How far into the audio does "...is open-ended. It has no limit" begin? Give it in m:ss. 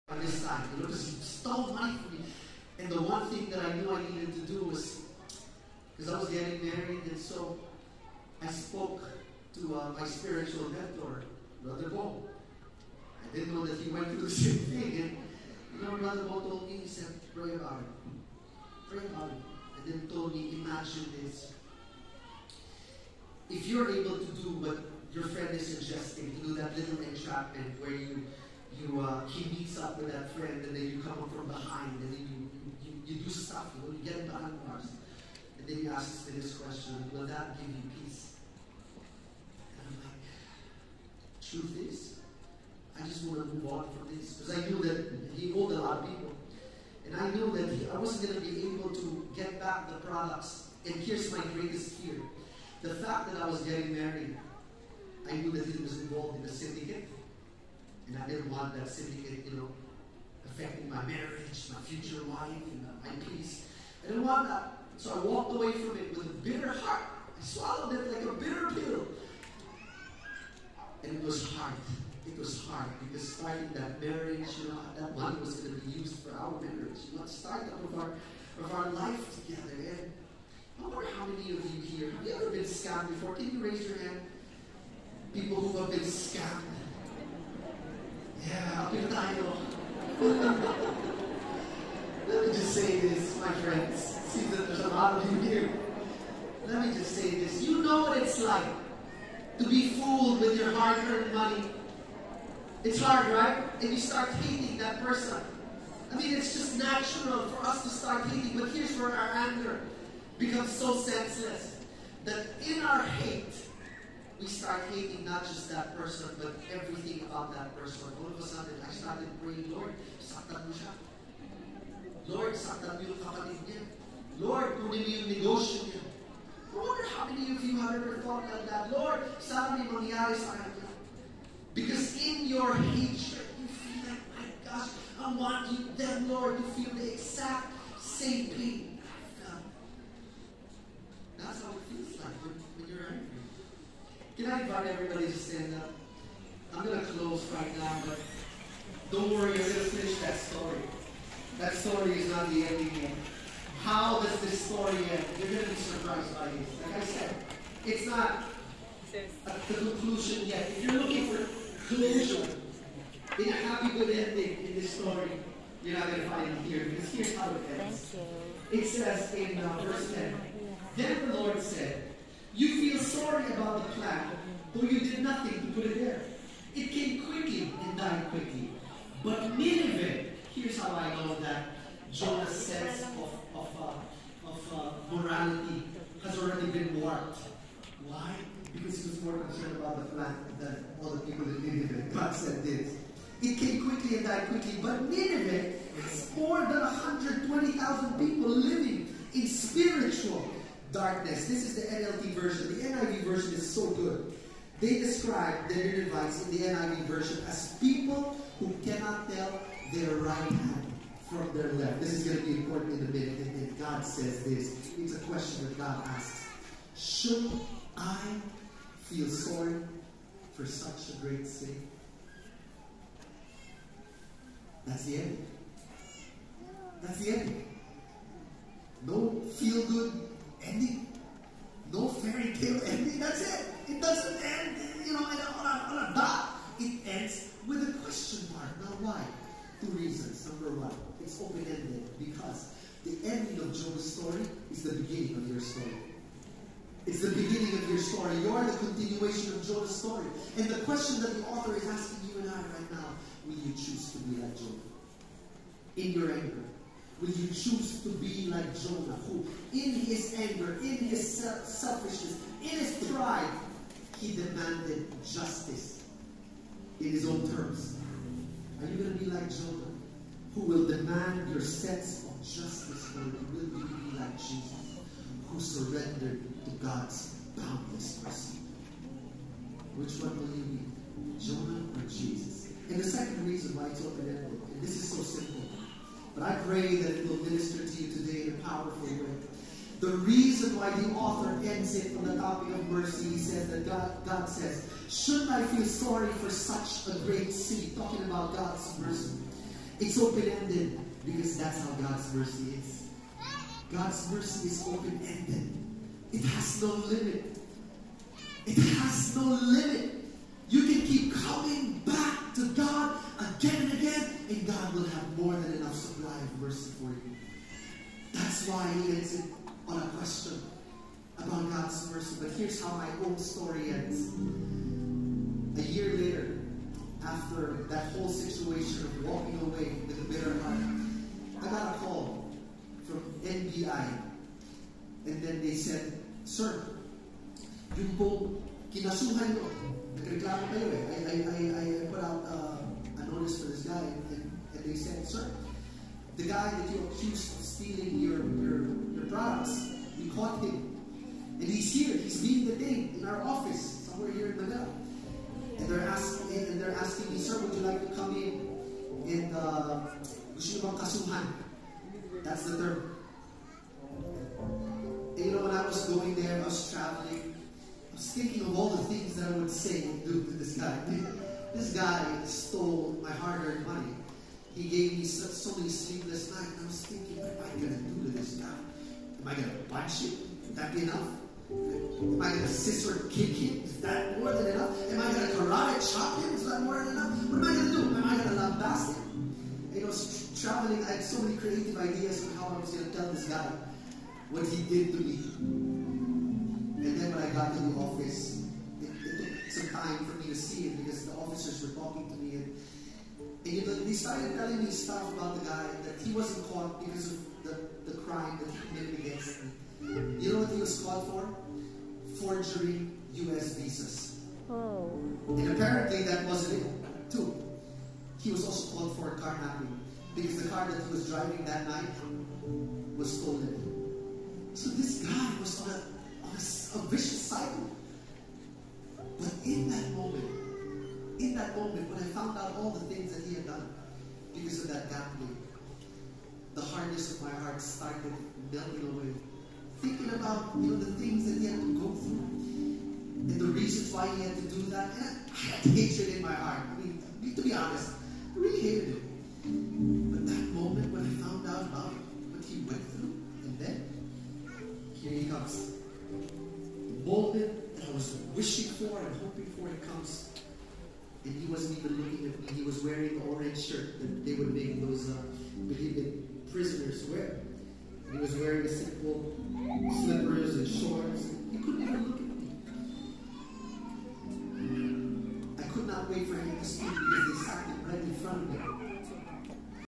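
5:04.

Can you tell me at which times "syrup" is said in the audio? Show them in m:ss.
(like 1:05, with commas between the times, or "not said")
not said.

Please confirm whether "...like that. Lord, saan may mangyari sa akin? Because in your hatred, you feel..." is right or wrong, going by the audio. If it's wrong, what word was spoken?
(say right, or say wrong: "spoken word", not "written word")
right.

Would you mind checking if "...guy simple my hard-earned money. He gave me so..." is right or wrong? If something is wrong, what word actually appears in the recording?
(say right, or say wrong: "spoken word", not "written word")
wrong: "stole", not "simple".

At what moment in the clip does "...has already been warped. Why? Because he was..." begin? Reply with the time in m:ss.
3:06.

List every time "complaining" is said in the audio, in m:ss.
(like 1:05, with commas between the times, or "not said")
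not said.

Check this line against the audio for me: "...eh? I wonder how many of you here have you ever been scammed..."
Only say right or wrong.
right.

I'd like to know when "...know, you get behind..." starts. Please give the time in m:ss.
0:33.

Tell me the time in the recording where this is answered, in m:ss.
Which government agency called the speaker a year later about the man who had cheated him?
5:33.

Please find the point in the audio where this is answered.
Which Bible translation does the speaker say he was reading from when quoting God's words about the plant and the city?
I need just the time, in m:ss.
3:21.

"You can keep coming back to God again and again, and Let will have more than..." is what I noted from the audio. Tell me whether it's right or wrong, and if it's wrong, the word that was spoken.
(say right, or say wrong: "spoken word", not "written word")
wrong: "God", not "Let".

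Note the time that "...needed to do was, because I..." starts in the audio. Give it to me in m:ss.
0:04.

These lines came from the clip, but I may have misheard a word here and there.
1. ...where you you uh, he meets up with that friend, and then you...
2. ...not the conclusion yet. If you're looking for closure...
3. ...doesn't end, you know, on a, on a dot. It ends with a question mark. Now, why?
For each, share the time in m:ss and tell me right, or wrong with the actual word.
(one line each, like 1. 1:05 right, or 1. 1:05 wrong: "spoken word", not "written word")
1. 0:27 right
2. 2:38 right
3. 3:54 right.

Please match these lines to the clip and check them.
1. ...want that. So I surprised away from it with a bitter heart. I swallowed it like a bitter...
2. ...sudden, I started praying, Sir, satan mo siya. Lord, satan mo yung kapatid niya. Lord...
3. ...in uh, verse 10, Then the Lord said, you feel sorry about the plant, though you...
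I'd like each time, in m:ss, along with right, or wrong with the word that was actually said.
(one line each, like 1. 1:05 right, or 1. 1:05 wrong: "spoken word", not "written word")
1. 1:04 wrong: "walked", not "surprised"
2. 1:58 wrong: "Lord", not "Sir"
3. 2:49 right.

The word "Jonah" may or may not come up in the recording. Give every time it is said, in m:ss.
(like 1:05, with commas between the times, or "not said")
3:02, 4:18, 4:29, 4:41.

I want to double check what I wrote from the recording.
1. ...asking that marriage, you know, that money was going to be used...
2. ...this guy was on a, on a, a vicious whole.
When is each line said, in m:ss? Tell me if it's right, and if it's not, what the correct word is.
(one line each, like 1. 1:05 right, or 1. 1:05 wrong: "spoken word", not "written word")
1. 1:13 wrong: "starting", not "asking"
2. 7:04 wrong: "cycle", not "whole".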